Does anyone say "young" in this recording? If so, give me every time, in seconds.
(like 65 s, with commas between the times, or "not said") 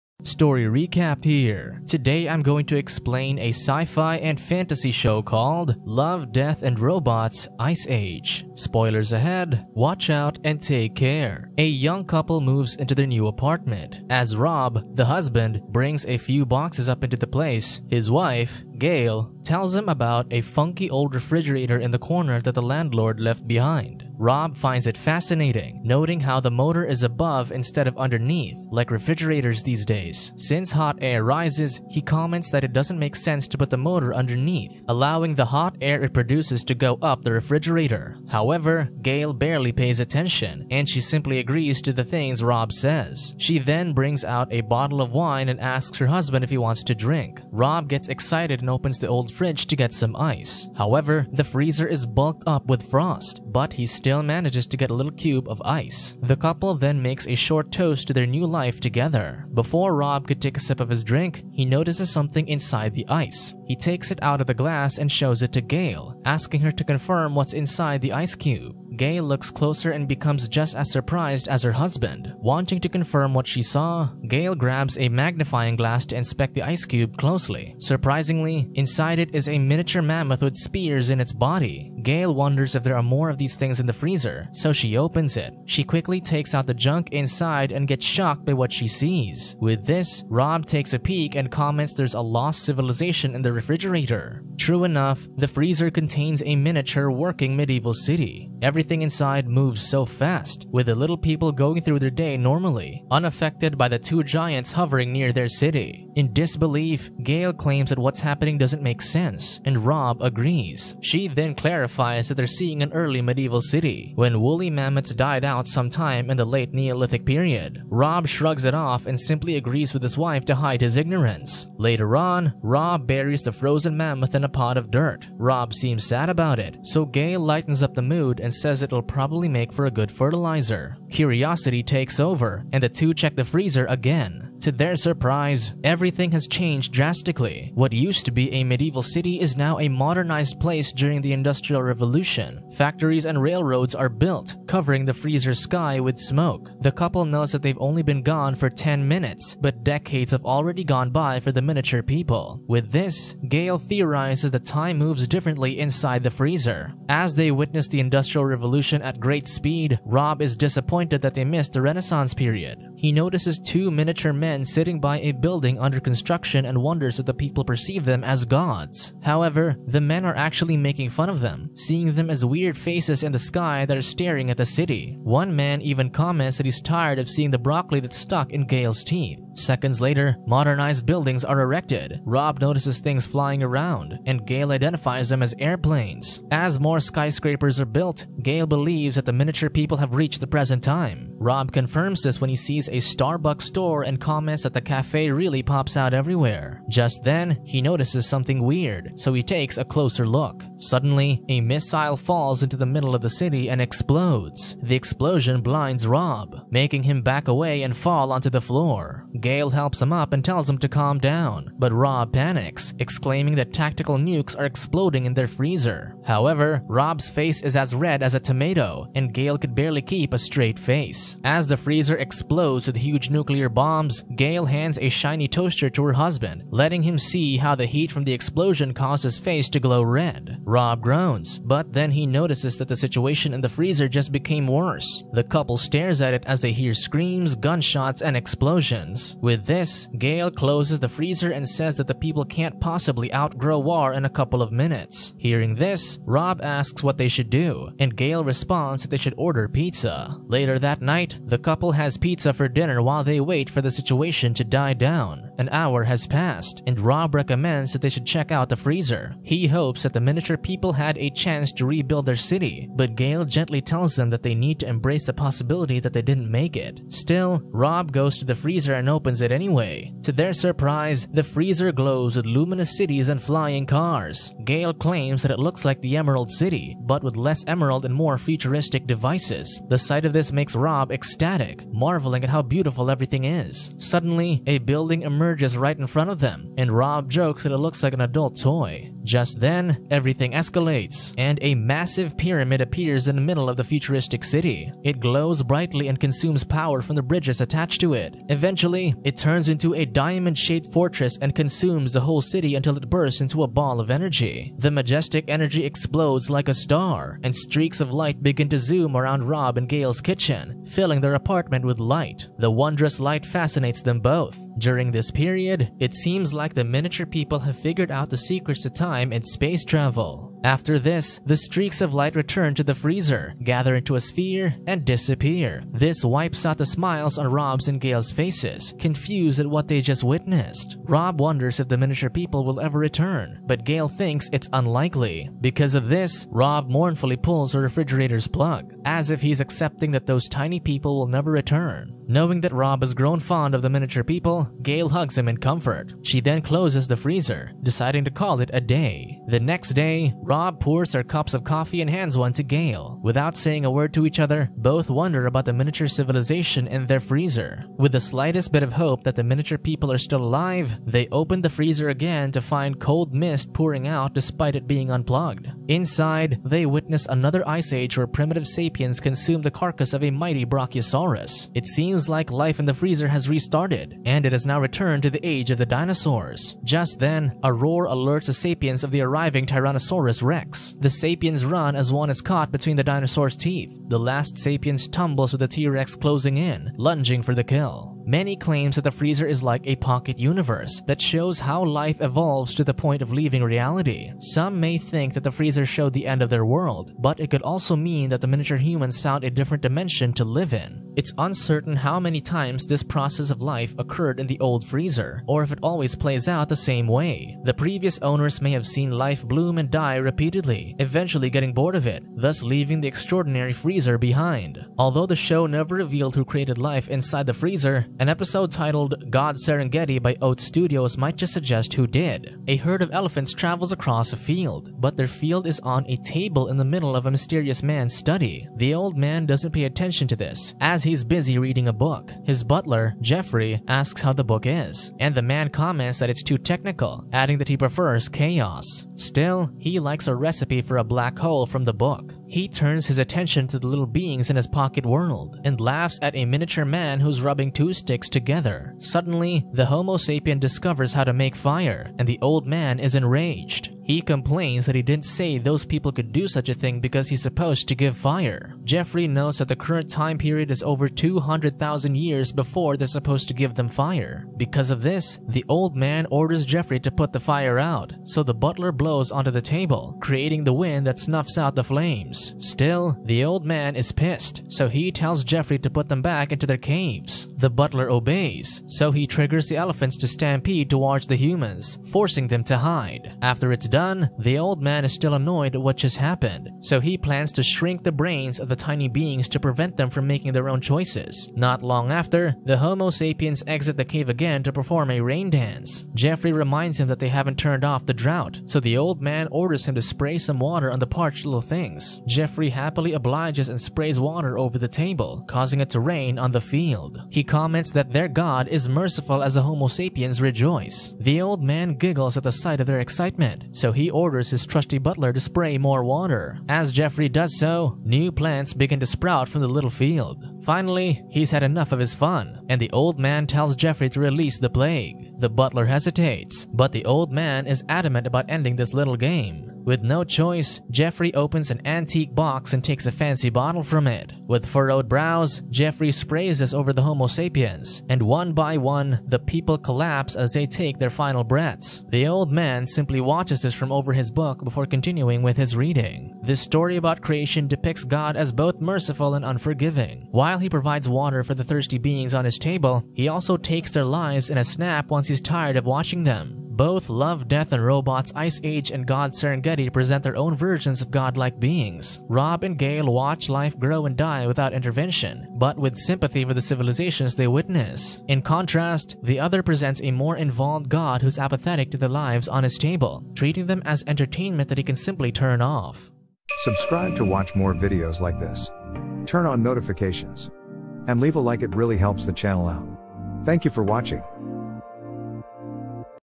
11 s.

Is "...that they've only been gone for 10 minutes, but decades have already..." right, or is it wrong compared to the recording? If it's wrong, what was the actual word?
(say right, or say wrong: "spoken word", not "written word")
right.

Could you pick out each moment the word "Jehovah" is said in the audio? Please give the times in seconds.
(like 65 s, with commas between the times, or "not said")
not said.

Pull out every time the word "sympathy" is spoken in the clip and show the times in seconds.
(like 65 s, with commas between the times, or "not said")
565 s.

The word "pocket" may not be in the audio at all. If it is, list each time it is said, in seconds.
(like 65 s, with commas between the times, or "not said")
389 s, 444 s.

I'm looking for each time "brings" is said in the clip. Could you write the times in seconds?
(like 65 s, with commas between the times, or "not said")
15 s, 43 s.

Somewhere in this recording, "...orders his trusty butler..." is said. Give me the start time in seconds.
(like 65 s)
514 s.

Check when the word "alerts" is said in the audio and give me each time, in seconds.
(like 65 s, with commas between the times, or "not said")
378 s.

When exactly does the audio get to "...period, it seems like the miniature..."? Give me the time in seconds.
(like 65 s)
315 s.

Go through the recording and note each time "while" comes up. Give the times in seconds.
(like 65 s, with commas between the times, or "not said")
253 s, 550 s.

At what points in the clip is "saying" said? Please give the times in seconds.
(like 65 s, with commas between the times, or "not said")
353 s.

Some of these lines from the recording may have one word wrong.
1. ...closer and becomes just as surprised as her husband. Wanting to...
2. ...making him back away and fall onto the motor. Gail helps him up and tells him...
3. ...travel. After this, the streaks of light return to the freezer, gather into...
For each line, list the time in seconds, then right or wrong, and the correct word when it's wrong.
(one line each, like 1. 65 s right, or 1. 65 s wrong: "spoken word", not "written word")
1. 69 s right
2. 206 s wrong: "floor", not "motor"
3. 319 s right.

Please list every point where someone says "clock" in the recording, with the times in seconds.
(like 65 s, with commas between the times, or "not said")
not said.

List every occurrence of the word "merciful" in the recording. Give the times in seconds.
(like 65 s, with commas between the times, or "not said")
508 s, 548 s.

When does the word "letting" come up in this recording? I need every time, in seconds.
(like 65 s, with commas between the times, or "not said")
226 s.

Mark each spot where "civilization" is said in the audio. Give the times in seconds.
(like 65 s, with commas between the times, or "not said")
92 s, 356 s, 566 s.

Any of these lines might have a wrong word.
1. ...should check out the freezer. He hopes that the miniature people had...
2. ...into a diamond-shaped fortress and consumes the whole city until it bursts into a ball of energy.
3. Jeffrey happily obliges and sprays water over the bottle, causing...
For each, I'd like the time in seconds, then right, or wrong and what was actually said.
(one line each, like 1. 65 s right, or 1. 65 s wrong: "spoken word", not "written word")
1. 258 s right
2. 299 s right
3. 502 s wrong: "table", not "bottle".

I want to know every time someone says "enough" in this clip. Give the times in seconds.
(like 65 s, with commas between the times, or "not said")
94 s, 521 s.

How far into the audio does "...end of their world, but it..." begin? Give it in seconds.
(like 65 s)
396 s.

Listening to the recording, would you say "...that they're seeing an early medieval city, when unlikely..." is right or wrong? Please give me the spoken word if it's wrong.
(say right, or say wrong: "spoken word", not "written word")
wrong: "woolly", not "unlikely".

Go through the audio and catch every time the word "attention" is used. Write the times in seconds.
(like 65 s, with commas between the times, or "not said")
39 s, 429 s, 443 s.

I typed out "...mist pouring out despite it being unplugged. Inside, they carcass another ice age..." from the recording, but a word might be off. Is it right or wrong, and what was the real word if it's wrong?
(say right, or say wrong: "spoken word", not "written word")
wrong: "witness", not "carcass".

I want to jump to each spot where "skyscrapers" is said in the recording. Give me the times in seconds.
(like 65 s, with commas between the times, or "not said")
187 s.